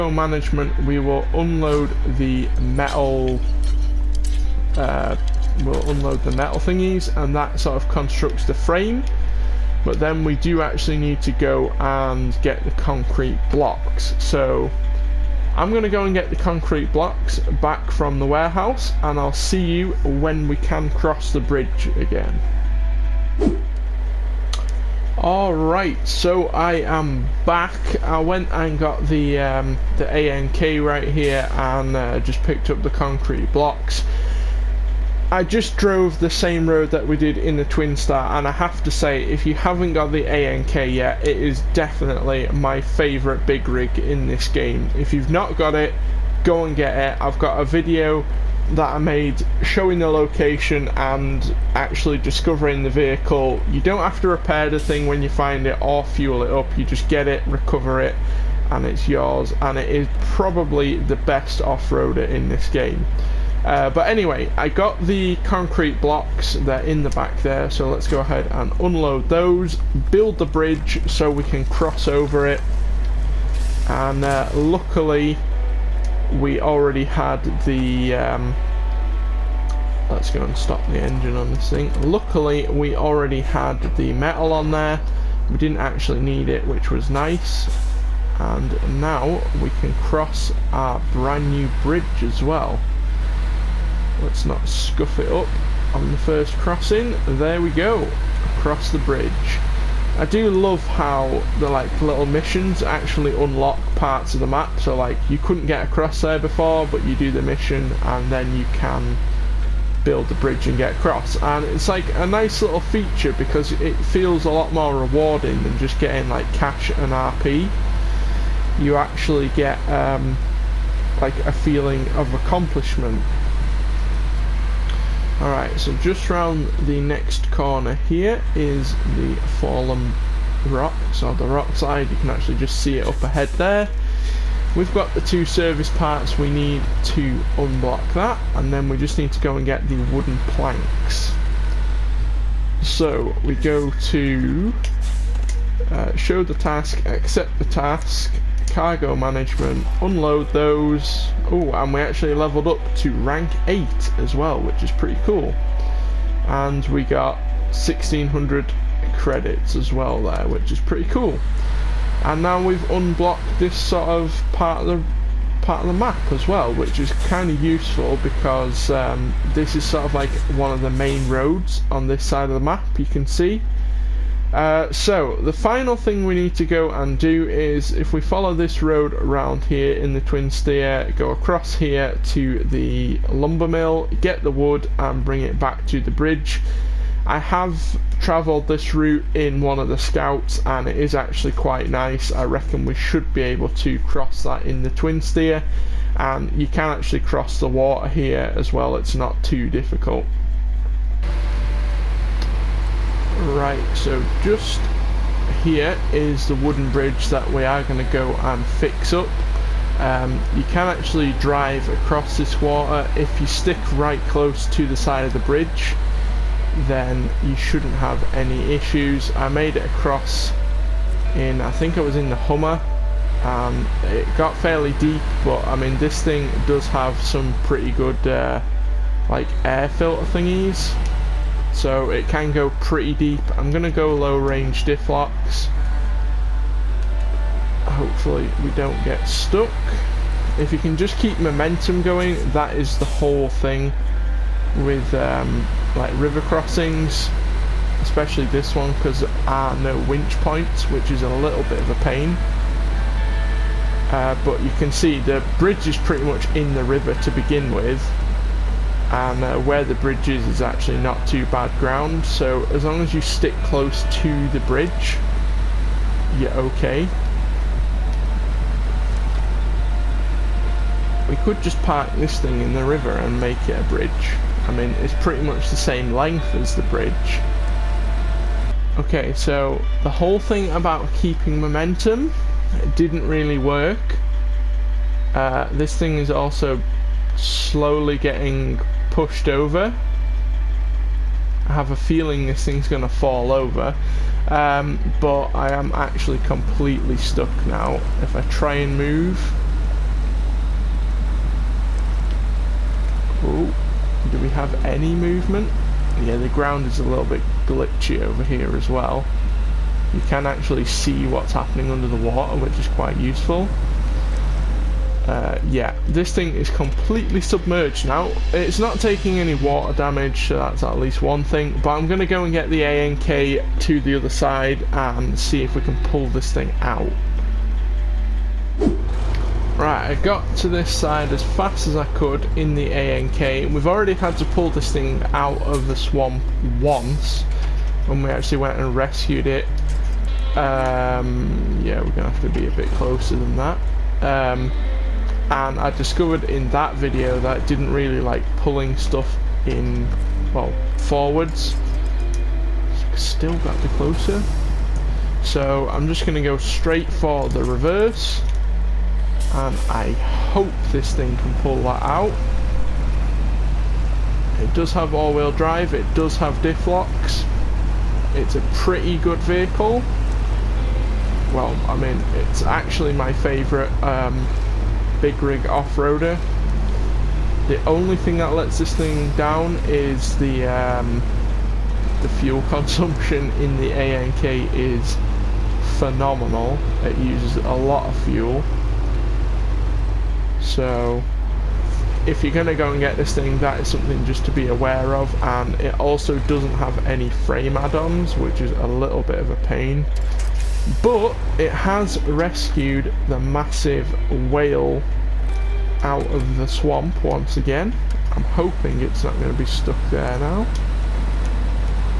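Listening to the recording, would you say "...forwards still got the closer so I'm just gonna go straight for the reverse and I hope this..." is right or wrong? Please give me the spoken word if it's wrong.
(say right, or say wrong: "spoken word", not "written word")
right.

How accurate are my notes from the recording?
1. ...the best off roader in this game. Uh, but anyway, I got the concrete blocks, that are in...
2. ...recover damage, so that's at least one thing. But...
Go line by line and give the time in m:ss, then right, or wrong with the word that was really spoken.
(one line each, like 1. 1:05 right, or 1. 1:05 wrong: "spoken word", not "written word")
1. 1:00 right
2. 5:19 wrong: "water", not "recover".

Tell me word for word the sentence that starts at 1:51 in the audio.
And it's like a nice little feature because it feels a lot more rewarding than just getting like cash and RP.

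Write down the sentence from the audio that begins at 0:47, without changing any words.
I've got a video that I made showing the location and actually discovering the vehicle.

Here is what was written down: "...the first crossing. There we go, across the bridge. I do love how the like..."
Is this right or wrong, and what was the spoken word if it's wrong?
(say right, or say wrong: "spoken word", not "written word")
right.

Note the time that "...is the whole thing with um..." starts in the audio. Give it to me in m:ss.
4:02.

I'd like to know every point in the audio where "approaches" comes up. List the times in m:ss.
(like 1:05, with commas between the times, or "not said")
not said.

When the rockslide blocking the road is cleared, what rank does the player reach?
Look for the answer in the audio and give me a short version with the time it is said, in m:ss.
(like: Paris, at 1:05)
8, at 2:33.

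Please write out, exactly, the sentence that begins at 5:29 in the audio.
Right, I got to this side as fast as I could in the ANK.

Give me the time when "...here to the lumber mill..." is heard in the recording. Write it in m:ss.
3:01.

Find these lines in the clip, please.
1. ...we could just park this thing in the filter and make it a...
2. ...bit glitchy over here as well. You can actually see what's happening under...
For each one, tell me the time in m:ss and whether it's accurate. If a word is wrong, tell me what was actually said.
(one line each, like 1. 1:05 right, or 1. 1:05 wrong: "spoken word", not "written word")
1. 4:31 wrong: "river", not "filter"
2. 5:07 right.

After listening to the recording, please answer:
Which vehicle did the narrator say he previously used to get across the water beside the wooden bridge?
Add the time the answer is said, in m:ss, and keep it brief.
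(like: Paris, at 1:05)
The Hummer, at 3:42.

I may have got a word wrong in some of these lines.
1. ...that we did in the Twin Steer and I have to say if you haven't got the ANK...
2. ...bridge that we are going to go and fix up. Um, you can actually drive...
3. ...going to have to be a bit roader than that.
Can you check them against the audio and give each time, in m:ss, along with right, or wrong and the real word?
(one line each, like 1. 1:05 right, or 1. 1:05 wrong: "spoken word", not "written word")
1. 0:36 right
2. 3:26 right
3. 5:42 wrong: "closer", not "roader".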